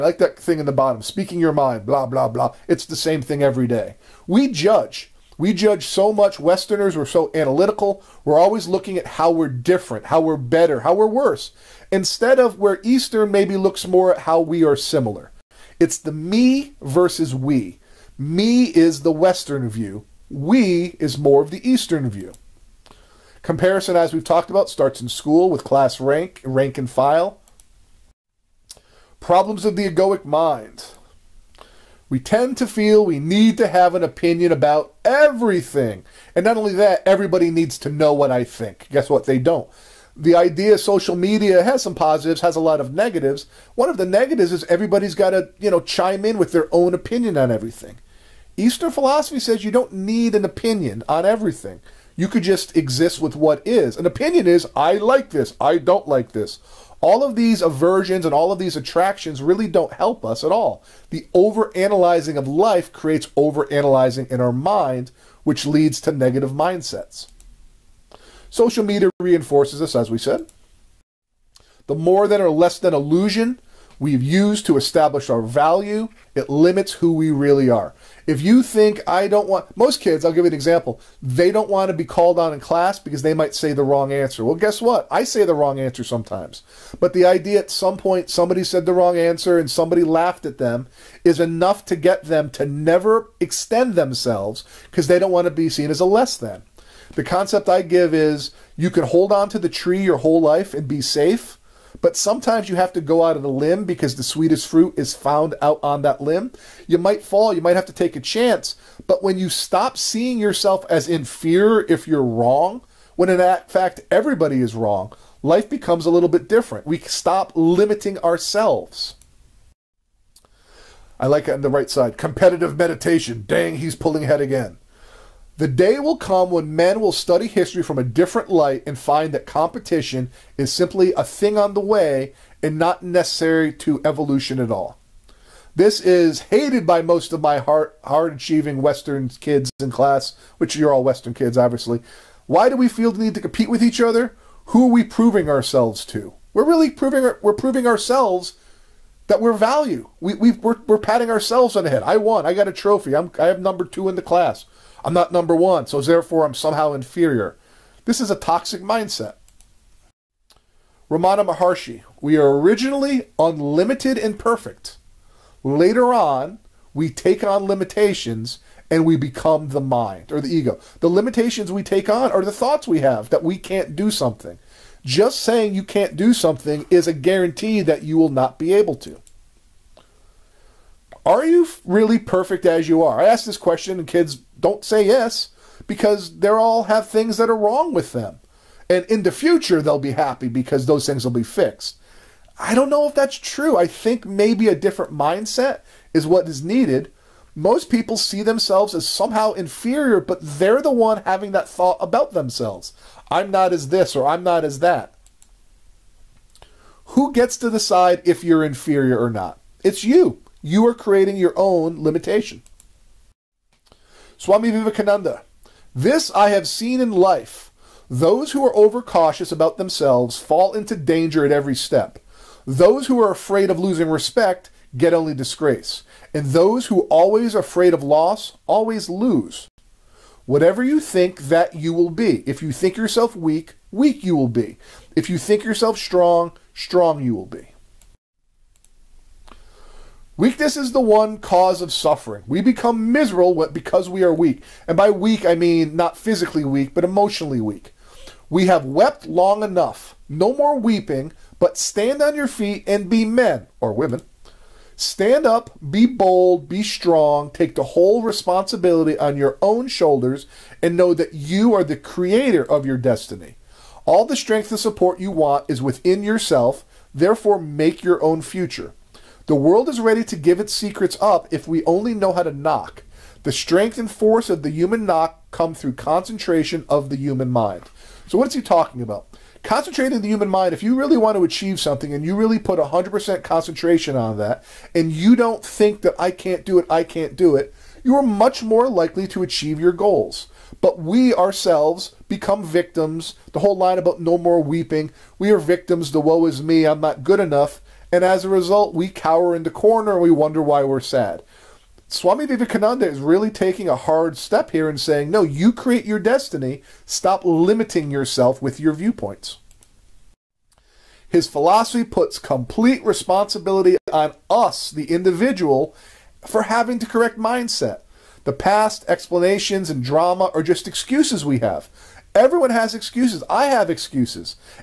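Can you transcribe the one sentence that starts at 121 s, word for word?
I like it on the right side.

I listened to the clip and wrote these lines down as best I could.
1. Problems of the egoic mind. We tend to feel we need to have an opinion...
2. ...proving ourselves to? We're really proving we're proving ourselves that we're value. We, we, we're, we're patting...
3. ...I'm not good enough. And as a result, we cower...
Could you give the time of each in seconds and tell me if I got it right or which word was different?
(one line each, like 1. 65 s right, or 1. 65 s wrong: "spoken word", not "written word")
1. 29 s right
2. 145 s right
3. 296 s right.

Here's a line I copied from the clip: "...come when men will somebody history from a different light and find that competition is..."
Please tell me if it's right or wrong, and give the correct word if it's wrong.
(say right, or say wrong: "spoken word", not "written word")
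wrong: "study", not "somebody".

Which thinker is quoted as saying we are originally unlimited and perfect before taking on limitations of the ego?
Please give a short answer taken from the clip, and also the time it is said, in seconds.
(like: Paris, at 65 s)
Ramana Maharshi, at 161 s.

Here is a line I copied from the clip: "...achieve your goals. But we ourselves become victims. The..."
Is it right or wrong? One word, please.
right.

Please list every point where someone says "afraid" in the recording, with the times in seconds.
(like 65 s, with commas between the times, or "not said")
223 s, 227 s.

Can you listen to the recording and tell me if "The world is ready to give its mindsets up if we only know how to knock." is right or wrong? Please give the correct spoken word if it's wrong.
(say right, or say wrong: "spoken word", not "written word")
wrong: "secrets", not "mindsets".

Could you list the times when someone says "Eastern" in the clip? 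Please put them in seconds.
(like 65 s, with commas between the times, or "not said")
12 s, 21 s, 48 s.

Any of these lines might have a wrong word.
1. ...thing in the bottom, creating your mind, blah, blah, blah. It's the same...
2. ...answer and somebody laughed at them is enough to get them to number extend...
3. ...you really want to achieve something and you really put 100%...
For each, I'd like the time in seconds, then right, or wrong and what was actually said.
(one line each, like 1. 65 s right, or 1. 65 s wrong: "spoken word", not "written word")
1. 0 s wrong: "speaking", not "creating"
2. 89 s wrong: "never", not "number"
3. 280 s right.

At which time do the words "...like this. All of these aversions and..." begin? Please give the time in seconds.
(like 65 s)
56 s.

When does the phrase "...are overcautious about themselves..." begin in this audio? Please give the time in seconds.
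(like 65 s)
218 s.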